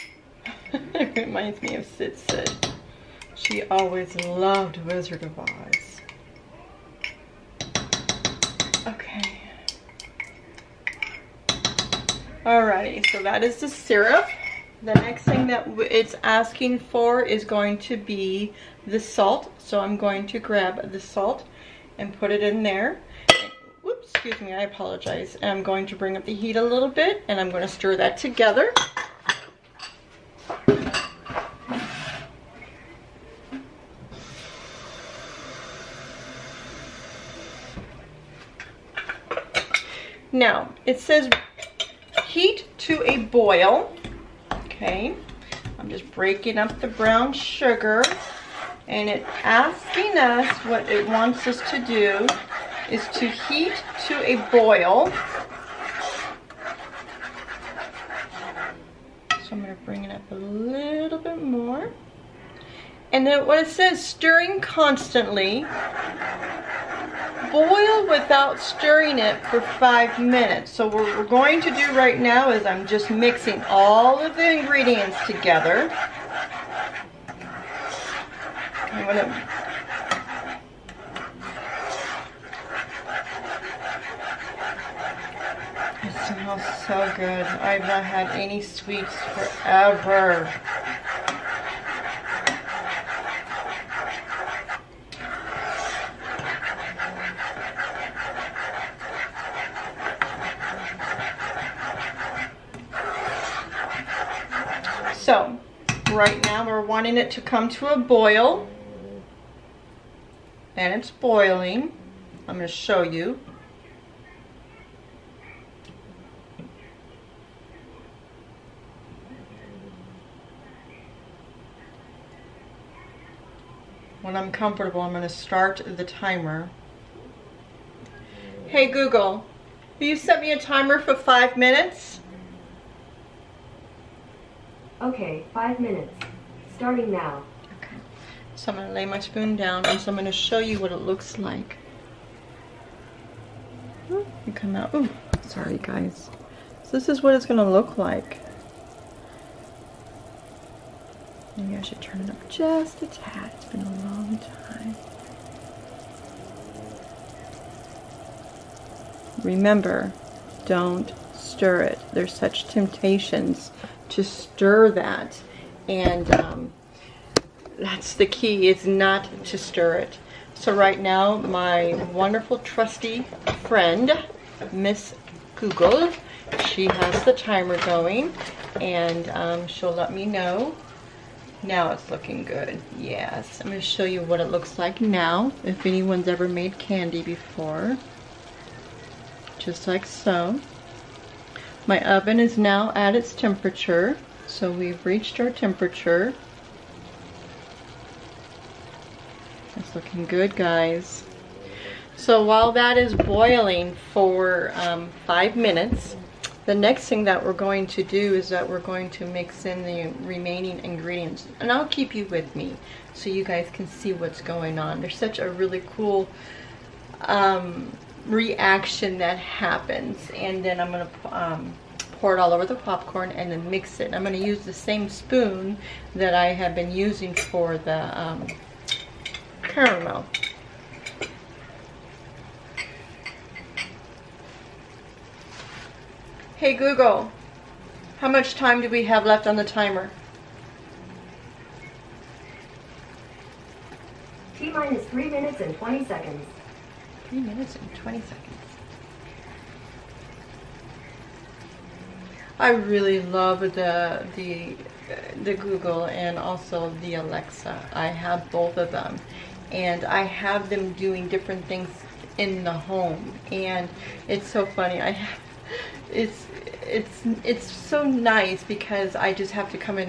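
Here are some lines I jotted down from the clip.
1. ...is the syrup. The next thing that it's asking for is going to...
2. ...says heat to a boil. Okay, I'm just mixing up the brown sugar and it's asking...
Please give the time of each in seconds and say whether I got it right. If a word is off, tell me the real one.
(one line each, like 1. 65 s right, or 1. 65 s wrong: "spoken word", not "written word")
1. 13 s right
2. 40 s wrong: "breaking", not "mixing".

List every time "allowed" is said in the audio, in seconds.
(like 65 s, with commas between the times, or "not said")
not said.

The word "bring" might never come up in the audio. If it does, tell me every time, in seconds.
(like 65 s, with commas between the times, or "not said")
25 s, 59 s.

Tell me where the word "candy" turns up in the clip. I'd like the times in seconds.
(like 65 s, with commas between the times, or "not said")
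186 s.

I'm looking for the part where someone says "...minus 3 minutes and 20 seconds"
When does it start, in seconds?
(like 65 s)
244 s.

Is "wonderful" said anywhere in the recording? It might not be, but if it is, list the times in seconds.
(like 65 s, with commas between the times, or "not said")
172 s.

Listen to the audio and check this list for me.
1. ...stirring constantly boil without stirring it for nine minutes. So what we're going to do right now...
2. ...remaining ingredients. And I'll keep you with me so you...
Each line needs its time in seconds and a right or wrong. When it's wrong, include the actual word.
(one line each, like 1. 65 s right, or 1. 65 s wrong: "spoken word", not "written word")
1. 64 s wrong: "five", not "nine"
2. 210 s right.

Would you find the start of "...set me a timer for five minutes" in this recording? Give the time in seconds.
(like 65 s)
130 s.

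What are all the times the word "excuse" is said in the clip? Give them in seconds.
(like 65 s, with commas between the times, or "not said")
24 s.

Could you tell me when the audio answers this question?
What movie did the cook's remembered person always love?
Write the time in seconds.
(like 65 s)
4 s.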